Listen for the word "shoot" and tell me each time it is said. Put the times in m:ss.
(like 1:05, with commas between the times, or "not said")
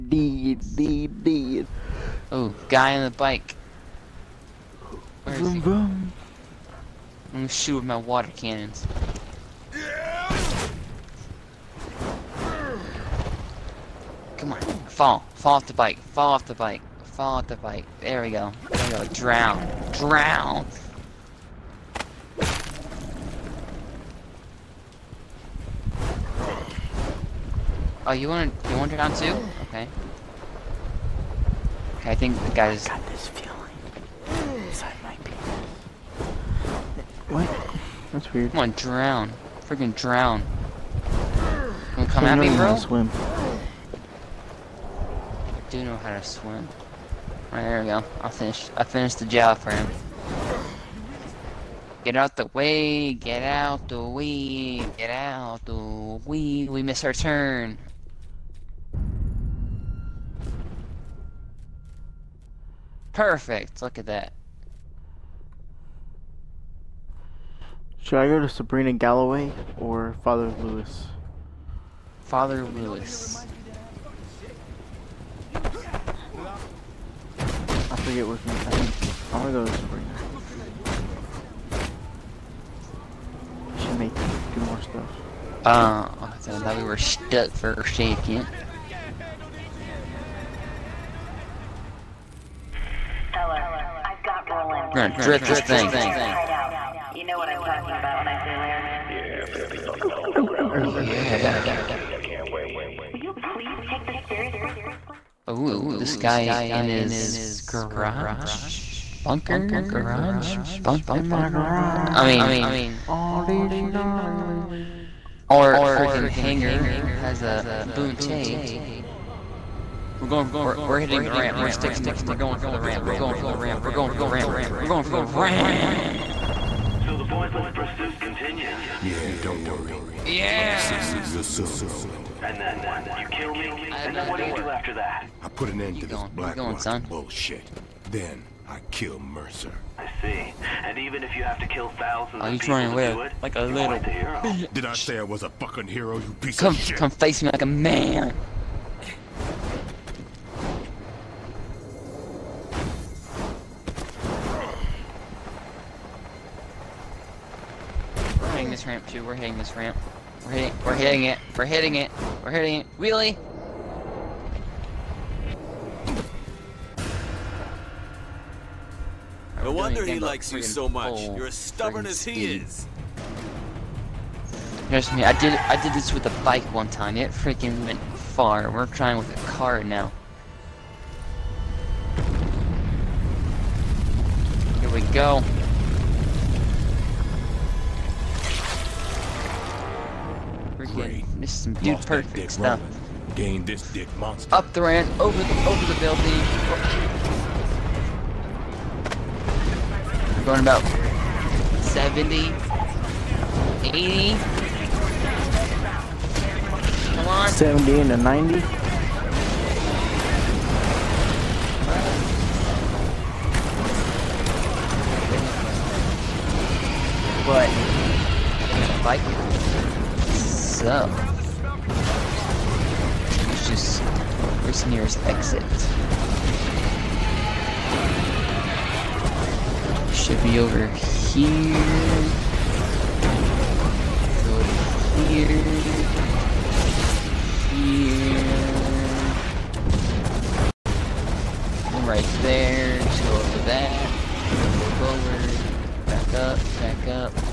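0:07.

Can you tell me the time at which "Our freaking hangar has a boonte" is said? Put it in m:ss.
1:55.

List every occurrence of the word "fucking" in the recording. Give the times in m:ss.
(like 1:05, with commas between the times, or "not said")
1:39, 2:25.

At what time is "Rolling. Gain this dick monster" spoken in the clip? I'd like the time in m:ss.
3:12.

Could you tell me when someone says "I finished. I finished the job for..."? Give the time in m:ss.
0:48.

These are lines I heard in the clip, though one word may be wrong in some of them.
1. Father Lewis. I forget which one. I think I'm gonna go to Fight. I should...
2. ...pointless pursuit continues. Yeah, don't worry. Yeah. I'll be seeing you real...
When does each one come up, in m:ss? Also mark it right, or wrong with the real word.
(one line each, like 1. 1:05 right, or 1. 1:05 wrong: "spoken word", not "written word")
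1. 1:12 wrong: "Sabrina", not "Fight"
2. 2:07 right.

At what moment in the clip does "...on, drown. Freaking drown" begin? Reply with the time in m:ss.
0:38.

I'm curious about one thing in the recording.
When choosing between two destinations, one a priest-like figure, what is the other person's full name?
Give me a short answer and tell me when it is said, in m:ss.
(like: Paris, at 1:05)
Sabrina Galloway, at 1:08.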